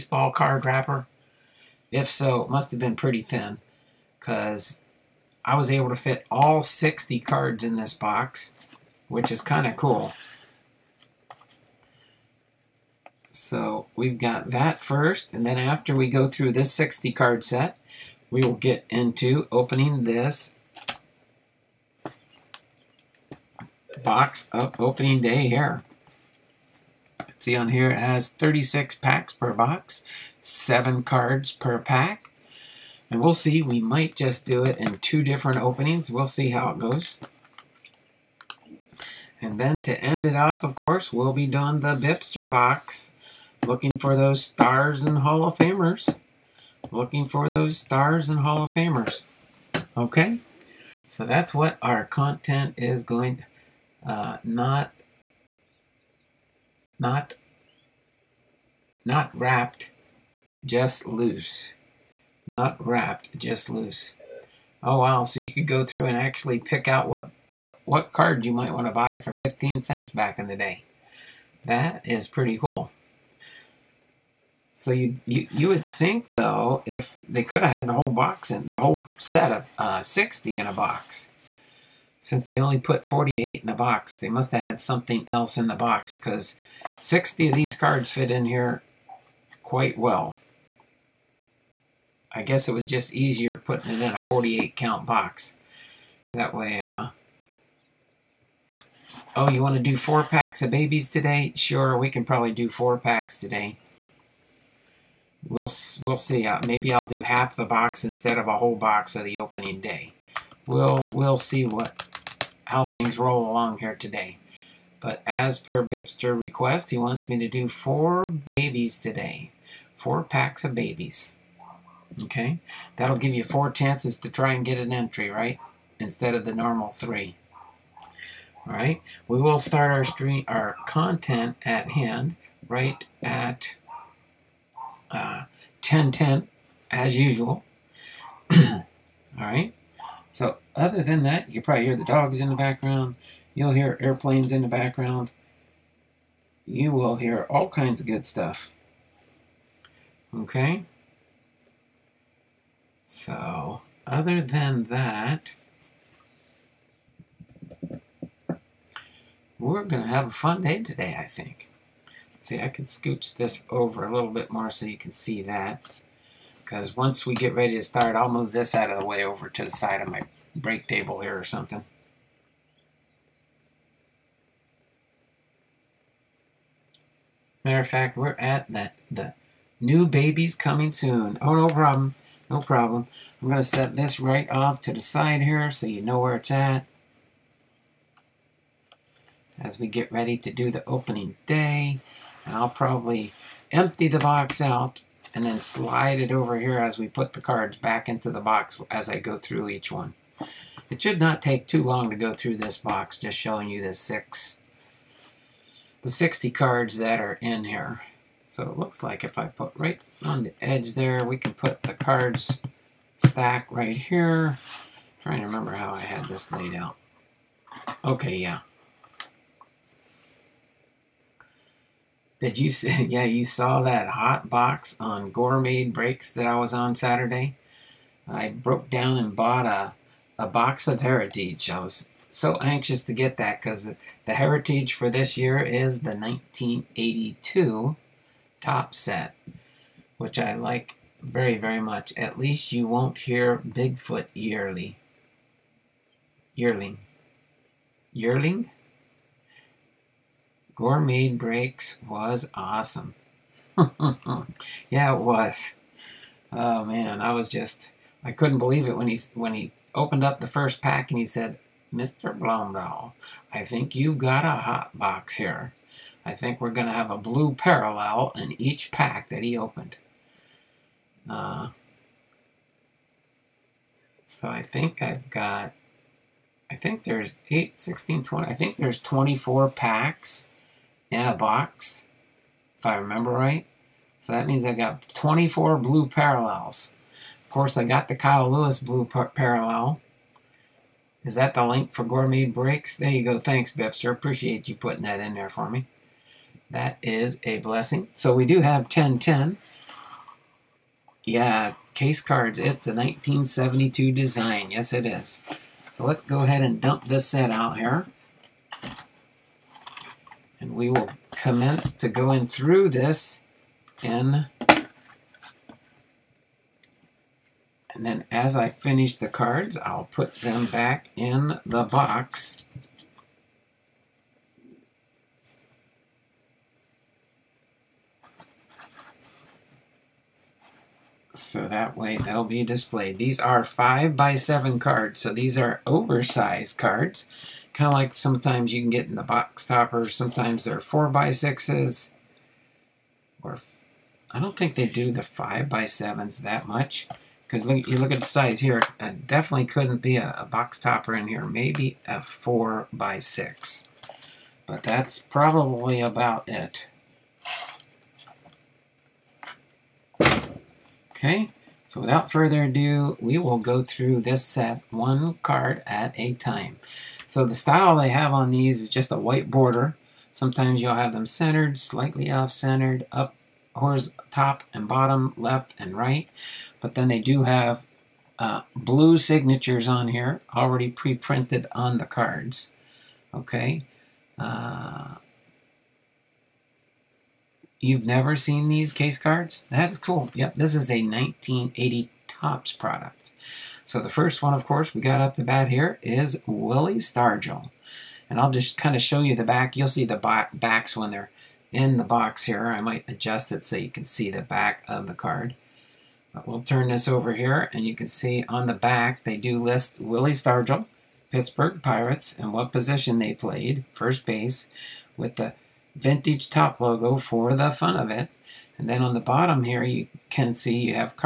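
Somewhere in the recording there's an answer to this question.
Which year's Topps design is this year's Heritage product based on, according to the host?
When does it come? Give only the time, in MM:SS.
03:56.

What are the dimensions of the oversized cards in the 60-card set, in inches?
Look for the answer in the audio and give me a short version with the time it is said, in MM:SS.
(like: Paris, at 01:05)
5 by 7, at 05:33.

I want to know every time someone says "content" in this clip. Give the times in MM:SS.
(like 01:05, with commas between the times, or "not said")
00:52, 02:10.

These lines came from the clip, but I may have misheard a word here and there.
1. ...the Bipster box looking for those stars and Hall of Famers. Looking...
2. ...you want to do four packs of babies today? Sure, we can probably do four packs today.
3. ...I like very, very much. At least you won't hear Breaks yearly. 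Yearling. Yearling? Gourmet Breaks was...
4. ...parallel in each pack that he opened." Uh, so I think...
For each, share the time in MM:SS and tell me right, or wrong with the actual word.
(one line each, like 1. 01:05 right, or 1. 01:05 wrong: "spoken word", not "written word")
1. 00:41 right
2. 01:39 right
3. 04:00 wrong: "Bigfoot", not "Breaks"
4. 04:27 right.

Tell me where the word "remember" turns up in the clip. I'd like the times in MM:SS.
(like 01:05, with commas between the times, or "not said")
03:35, 04:42.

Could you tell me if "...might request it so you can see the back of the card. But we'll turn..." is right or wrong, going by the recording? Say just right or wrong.
wrong.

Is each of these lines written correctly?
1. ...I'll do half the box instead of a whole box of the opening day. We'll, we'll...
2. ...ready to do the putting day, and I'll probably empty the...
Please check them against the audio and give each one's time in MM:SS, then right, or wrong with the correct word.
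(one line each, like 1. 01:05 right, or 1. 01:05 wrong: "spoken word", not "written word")
1. 01:46 right
2. 03:10 wrong: "opening", not "putting".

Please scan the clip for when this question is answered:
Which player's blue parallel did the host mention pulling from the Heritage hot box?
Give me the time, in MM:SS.
04:48.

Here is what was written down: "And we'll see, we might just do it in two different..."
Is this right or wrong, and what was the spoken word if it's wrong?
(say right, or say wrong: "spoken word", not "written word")
right.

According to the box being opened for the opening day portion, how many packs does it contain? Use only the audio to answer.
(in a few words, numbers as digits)
36.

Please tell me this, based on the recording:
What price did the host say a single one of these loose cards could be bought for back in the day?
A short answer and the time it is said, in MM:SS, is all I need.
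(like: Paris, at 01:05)
15 cents, at 01:09.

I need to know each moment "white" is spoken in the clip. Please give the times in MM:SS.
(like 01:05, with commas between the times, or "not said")
06:09.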